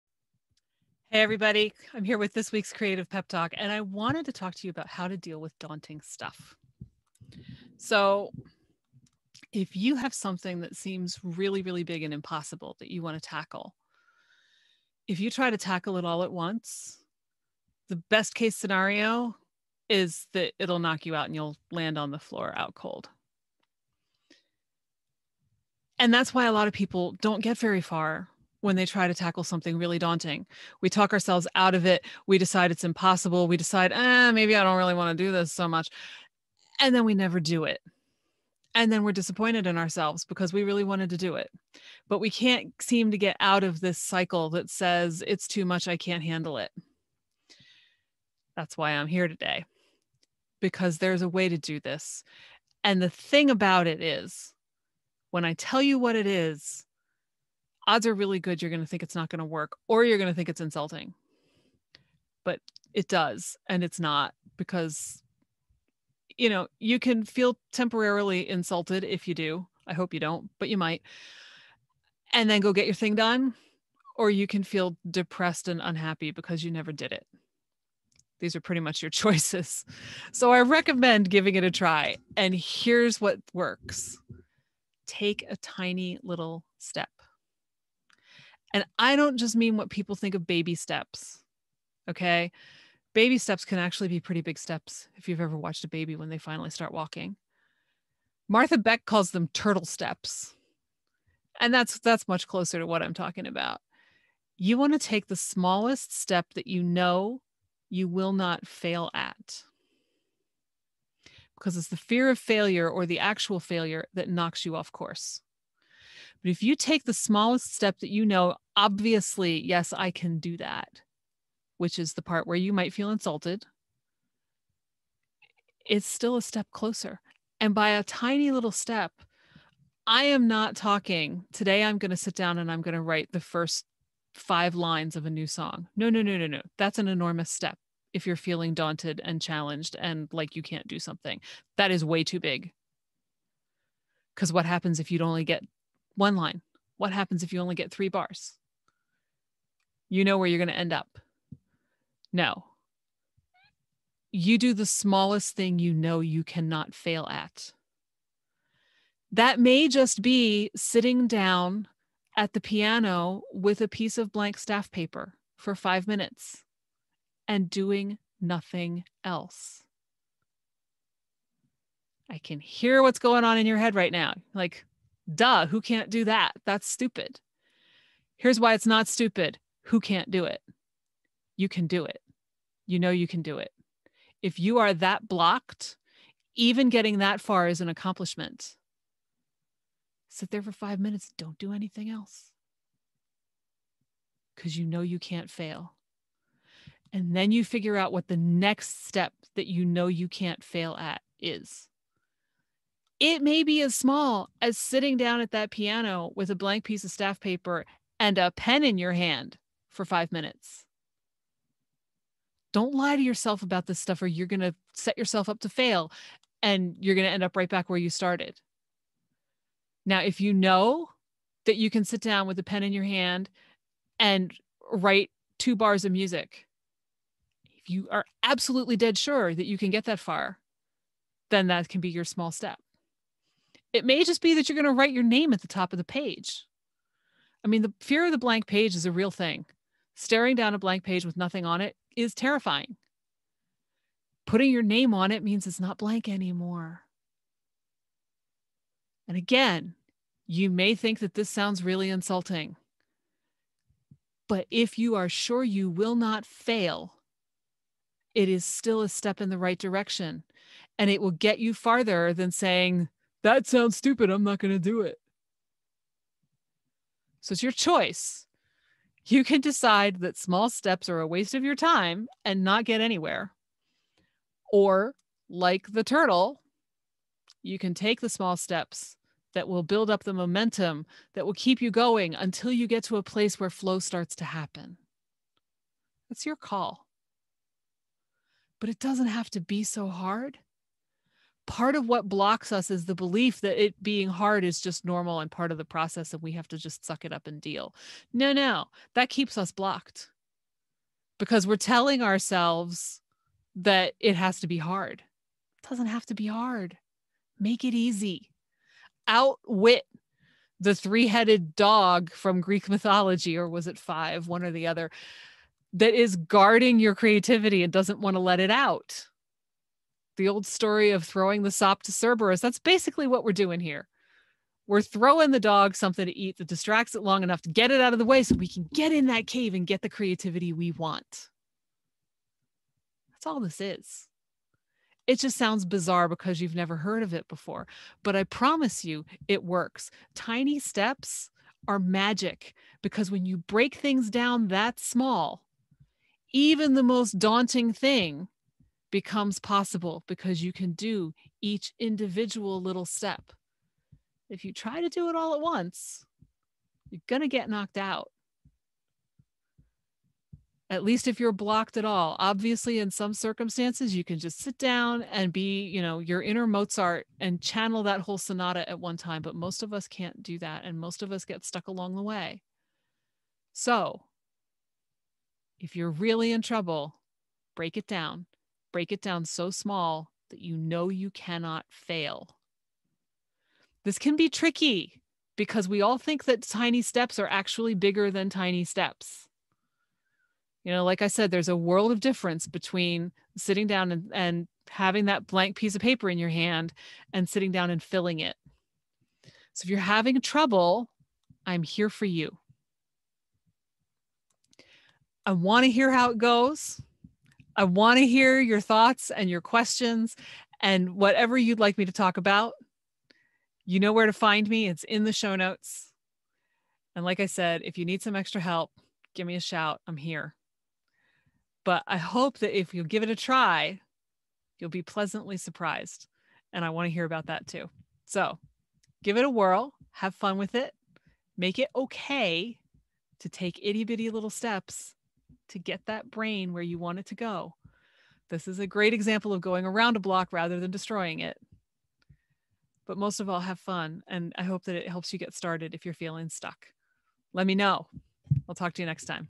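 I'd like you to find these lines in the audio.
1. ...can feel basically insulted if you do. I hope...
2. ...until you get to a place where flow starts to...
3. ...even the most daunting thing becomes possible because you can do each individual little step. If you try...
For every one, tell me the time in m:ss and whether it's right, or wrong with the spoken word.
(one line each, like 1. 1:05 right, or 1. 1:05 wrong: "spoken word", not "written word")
1. 1:06 wrong: "temporarily", not "basically"
2. 4:42 right
3. 5:46 right.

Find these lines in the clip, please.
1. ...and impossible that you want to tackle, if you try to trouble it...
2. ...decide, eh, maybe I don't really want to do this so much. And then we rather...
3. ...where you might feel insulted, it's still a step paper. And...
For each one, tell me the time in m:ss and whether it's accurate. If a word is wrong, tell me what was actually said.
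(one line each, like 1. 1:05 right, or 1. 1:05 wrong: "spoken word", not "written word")
1. 0:12 wrong: "tackle", not "trouble"
2. 0:33 wrong: "never", not "rather"
3. 2:02 wrong: "closer", not "paper".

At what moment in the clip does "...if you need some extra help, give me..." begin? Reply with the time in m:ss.
6:57.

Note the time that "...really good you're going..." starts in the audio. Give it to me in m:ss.
0:58.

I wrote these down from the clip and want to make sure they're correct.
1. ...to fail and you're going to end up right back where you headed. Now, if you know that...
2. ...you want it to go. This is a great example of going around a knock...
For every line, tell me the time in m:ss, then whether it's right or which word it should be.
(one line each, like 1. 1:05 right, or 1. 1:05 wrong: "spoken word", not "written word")
1. 3:35 wrong: "started", not "headed"
2. 7:16 wrong: "block", not "knock".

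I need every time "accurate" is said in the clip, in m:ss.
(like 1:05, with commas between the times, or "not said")
not said.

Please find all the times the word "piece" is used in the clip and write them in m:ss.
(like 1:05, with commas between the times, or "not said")
2:43, 3:26, 6:35.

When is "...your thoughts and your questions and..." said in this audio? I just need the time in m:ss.
6:48.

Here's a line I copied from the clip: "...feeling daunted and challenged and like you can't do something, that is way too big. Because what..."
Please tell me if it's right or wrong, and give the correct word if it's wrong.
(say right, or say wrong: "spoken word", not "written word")
right.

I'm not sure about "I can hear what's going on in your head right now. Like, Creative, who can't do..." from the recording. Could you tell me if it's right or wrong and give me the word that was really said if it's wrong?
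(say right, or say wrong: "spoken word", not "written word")
wrong: "Duh", not "Creative".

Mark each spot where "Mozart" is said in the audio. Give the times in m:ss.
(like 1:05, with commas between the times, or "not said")
6:06.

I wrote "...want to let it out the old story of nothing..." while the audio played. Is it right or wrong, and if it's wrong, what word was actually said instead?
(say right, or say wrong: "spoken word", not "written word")
wrong: "throwing", not "nothing".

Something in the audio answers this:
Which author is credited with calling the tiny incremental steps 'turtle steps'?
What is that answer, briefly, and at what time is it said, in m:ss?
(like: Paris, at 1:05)
Martha Beck, at 1:38.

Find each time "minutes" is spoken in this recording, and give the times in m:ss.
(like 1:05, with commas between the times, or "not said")
2:46, 3:10, 3:30.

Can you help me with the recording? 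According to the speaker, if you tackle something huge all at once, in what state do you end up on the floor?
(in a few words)
out cold.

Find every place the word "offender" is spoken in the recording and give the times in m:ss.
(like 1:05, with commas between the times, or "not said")
not said.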